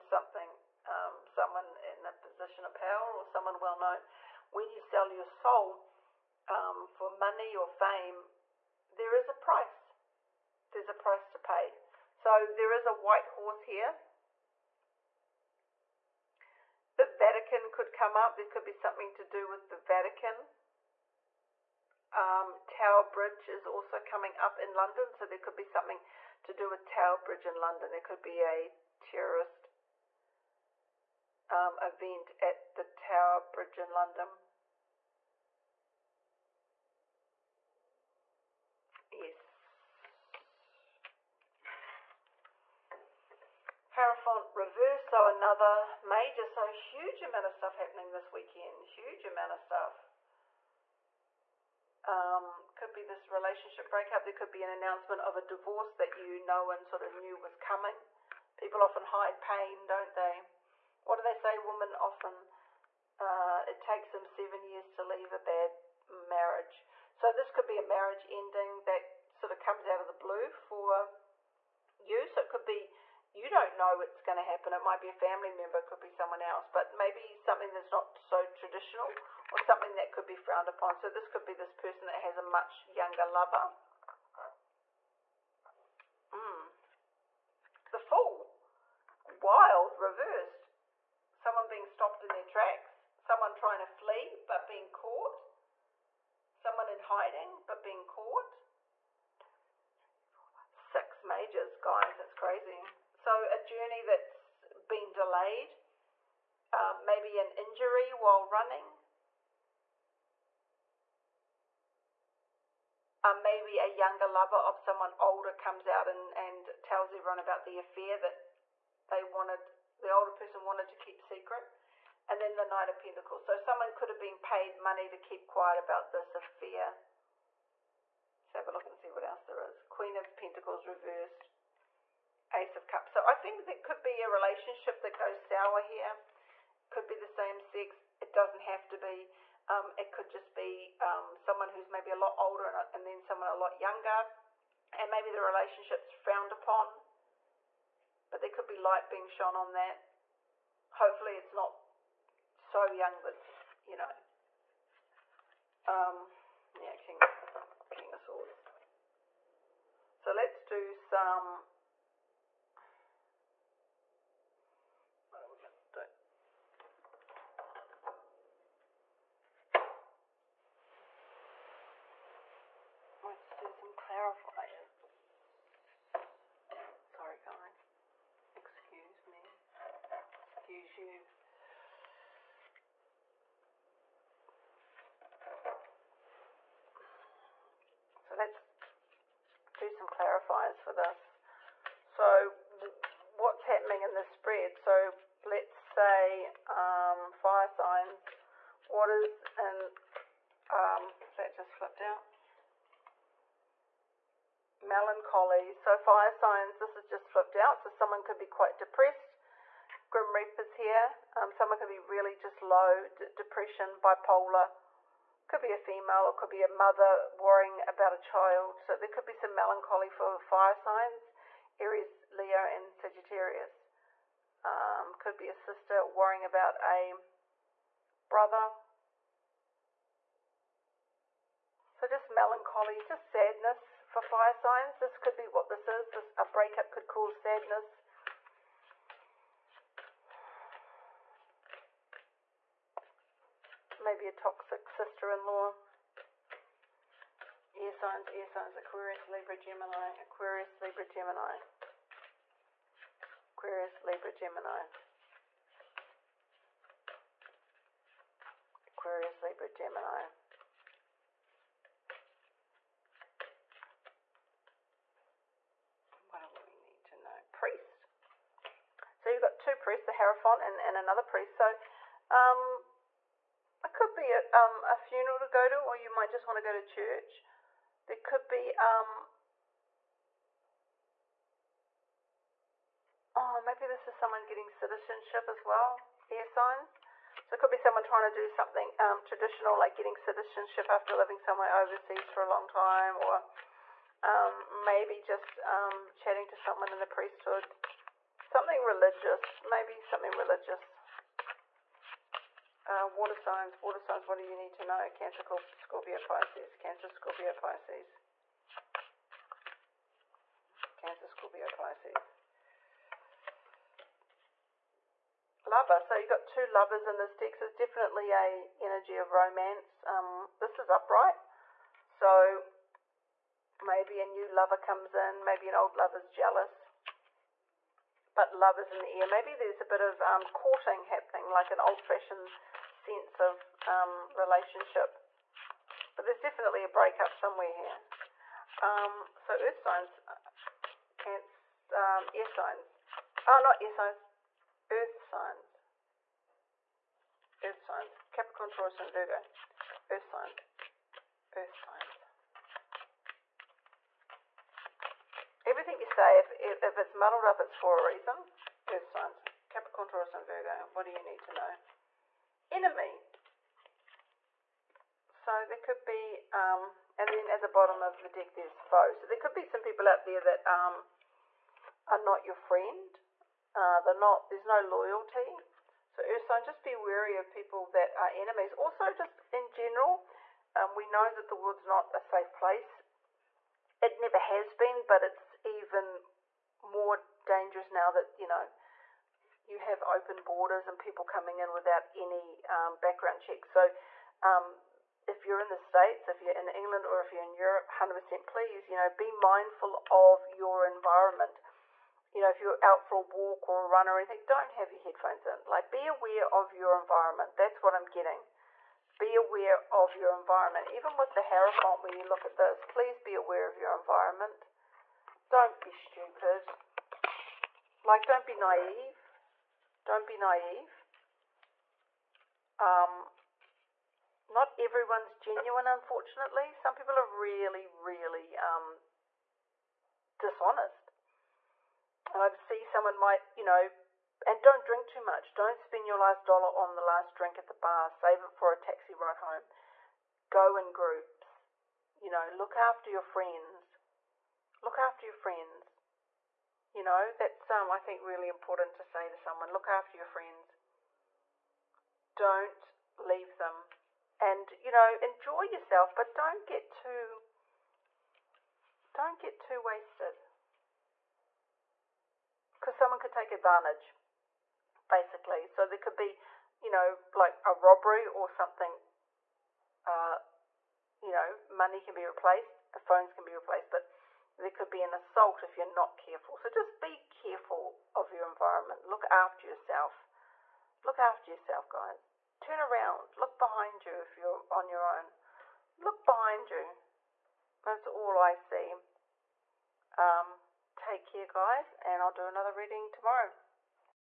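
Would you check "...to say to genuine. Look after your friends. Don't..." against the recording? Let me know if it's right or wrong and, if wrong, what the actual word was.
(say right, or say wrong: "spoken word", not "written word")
wrong: "someone", not "genuine".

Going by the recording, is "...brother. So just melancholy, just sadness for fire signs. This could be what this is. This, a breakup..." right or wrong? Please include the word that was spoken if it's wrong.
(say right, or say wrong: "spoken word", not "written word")
right.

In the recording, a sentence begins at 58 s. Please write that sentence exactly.
People often hide pain, don't they?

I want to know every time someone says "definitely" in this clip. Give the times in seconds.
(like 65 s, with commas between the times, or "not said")
317 s, 336 s.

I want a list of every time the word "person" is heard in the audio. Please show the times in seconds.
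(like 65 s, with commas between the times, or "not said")
81 s, 120 s.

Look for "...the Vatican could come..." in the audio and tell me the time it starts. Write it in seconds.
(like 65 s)
16 s.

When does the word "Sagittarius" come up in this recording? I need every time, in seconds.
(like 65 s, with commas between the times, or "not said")
222 s.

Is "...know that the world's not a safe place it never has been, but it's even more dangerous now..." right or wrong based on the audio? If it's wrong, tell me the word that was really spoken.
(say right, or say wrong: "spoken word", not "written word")
right.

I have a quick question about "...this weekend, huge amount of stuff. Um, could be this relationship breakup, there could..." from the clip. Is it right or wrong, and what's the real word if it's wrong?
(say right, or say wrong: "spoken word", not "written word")
right.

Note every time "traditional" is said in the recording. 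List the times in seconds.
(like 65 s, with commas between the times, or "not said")
78 s, 289 s.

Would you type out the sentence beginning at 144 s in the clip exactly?
And maybe the relationship's frowned upon.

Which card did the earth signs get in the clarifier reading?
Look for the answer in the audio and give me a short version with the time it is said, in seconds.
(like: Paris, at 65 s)
Enemy, at 362 s.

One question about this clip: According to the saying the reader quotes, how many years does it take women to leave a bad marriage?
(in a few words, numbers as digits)
7.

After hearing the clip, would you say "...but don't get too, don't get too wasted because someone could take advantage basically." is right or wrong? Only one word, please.
right.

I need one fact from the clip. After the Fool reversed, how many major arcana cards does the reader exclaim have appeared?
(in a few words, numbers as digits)
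6.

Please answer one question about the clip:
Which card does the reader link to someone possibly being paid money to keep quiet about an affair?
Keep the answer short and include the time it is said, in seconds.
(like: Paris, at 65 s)
Knight of Pentacles, at 122 s.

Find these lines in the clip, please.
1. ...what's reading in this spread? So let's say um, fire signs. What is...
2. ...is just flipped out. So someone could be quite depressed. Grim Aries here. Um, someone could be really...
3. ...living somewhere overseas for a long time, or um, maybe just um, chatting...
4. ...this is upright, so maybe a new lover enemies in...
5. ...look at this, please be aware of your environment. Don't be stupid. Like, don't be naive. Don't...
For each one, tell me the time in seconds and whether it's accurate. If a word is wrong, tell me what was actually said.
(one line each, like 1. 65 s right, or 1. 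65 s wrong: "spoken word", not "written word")
1. 193 s wrong: "happening", not "reading"
2. 206 s wrong: "Reapers", not "Aries"
3. 291 s right
4. 320 s wrong: "comes", not "enemies"
5. 412 s right.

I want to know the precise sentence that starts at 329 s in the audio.
Maybe there's a bit of um, courting happening, like an old-fashioned sense of um, relationship.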